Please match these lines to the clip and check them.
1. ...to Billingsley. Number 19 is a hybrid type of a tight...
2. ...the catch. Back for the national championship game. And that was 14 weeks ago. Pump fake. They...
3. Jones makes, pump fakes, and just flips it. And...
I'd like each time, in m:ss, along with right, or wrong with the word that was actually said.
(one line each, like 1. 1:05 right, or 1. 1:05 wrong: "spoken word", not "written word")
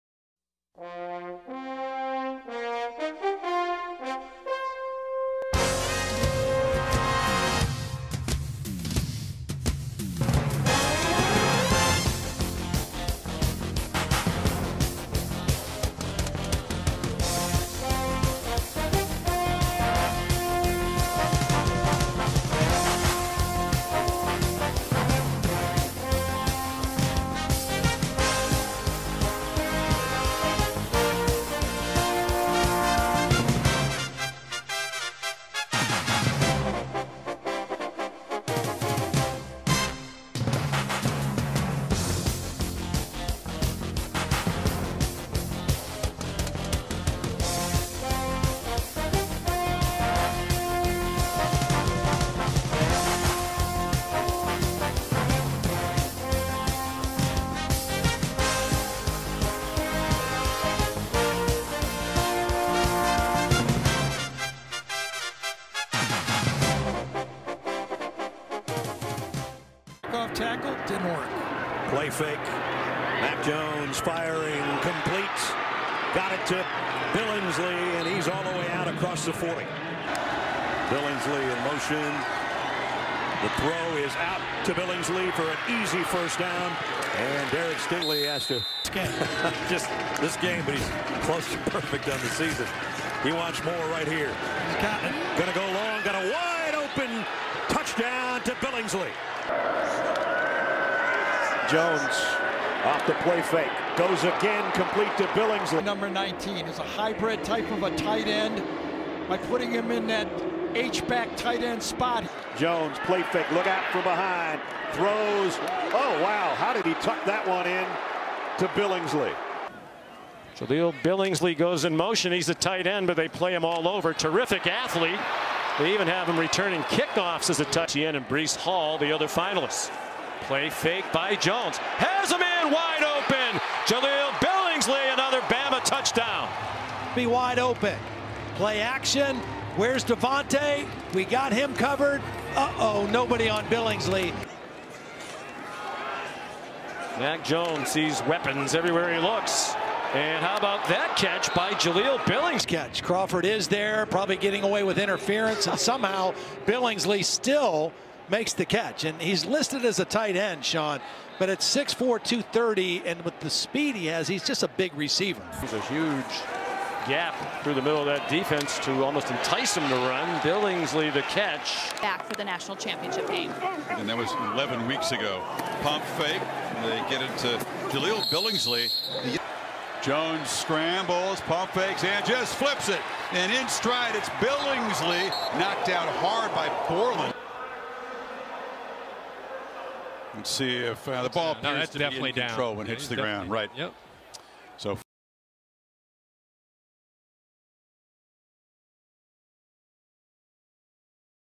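1. 1:45 right
2. 2:51 wrong: "11", not "14"
3. 3:00 wrong: "scrambles", not "makes".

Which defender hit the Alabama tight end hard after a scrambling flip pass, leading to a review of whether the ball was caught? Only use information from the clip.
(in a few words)
Borland.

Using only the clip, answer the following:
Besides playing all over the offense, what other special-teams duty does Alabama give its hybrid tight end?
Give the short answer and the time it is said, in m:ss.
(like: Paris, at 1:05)
Returning kickoffs, at 2:06.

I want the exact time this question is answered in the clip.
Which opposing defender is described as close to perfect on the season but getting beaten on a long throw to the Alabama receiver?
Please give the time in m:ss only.
1:27.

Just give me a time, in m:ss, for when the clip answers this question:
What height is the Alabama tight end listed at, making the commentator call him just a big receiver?
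2:41.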